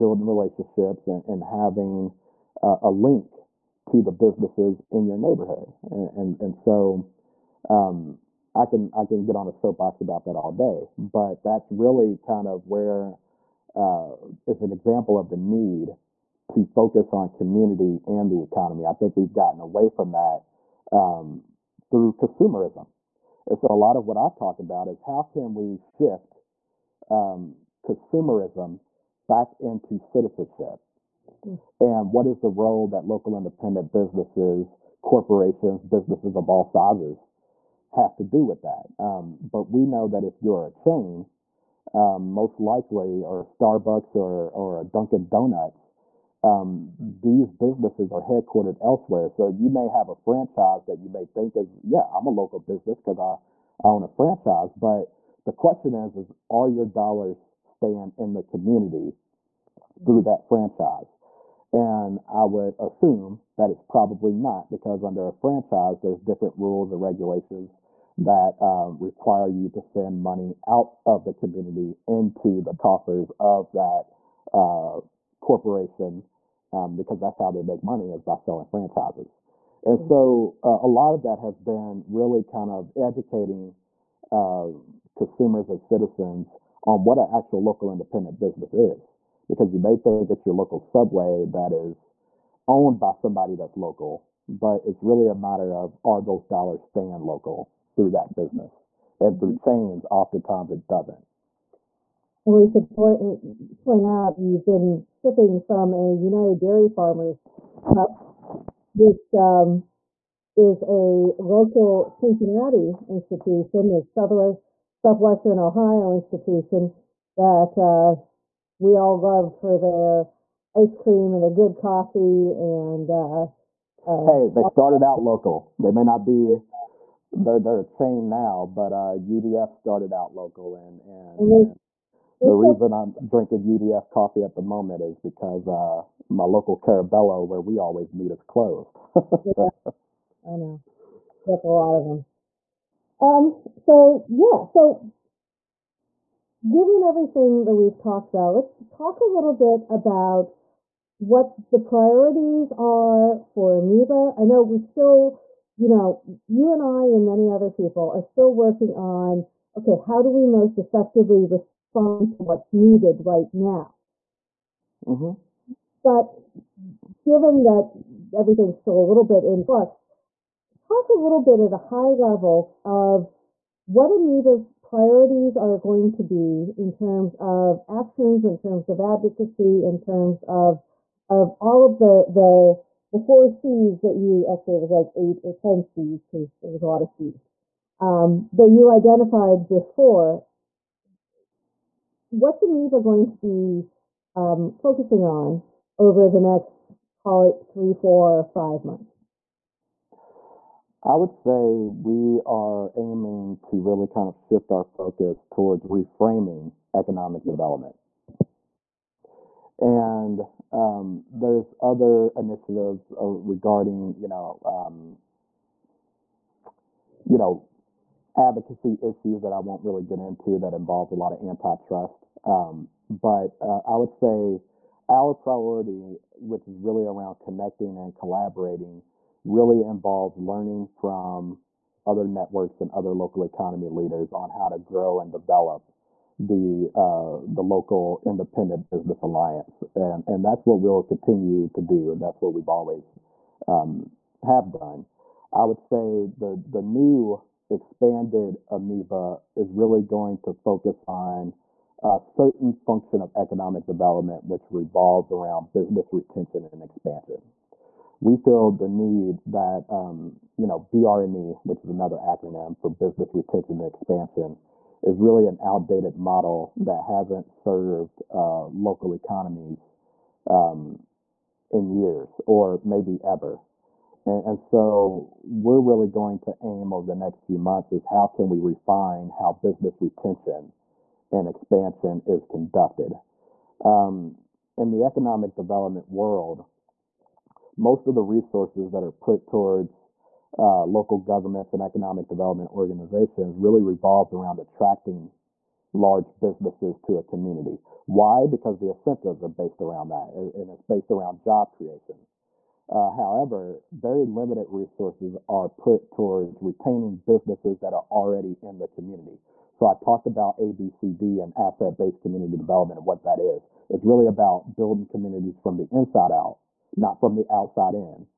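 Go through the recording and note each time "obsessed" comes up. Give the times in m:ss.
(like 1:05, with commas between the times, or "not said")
not said.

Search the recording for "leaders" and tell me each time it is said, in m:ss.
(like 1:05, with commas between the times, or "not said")
3:53.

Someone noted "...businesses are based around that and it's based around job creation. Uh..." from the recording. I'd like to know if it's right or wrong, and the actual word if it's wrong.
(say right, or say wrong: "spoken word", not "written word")
wrong: "incentives", not "businesses".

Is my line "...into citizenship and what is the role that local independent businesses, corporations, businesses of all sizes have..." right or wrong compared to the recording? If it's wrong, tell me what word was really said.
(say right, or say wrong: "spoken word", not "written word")
right.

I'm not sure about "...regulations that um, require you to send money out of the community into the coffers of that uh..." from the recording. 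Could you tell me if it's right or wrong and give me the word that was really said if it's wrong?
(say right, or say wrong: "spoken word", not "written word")
right.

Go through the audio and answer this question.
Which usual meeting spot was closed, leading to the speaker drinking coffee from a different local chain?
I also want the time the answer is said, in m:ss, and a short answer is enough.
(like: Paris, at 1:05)
Carabello, at 2:16.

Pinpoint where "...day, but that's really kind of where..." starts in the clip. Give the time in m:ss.
0:10.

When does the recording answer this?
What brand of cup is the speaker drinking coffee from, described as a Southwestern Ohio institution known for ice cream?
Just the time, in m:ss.
1:46.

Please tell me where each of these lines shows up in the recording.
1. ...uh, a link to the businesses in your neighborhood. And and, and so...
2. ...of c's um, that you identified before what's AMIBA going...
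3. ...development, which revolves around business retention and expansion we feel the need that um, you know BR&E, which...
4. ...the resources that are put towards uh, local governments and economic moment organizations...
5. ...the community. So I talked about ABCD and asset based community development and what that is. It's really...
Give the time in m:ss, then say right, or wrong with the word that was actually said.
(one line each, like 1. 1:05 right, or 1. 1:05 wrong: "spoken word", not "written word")
1. 0:02 right
2. 3:07 right
3. 4:13 right
4. 4:48 wrong: "development", not "moment"
5. 5:08 right.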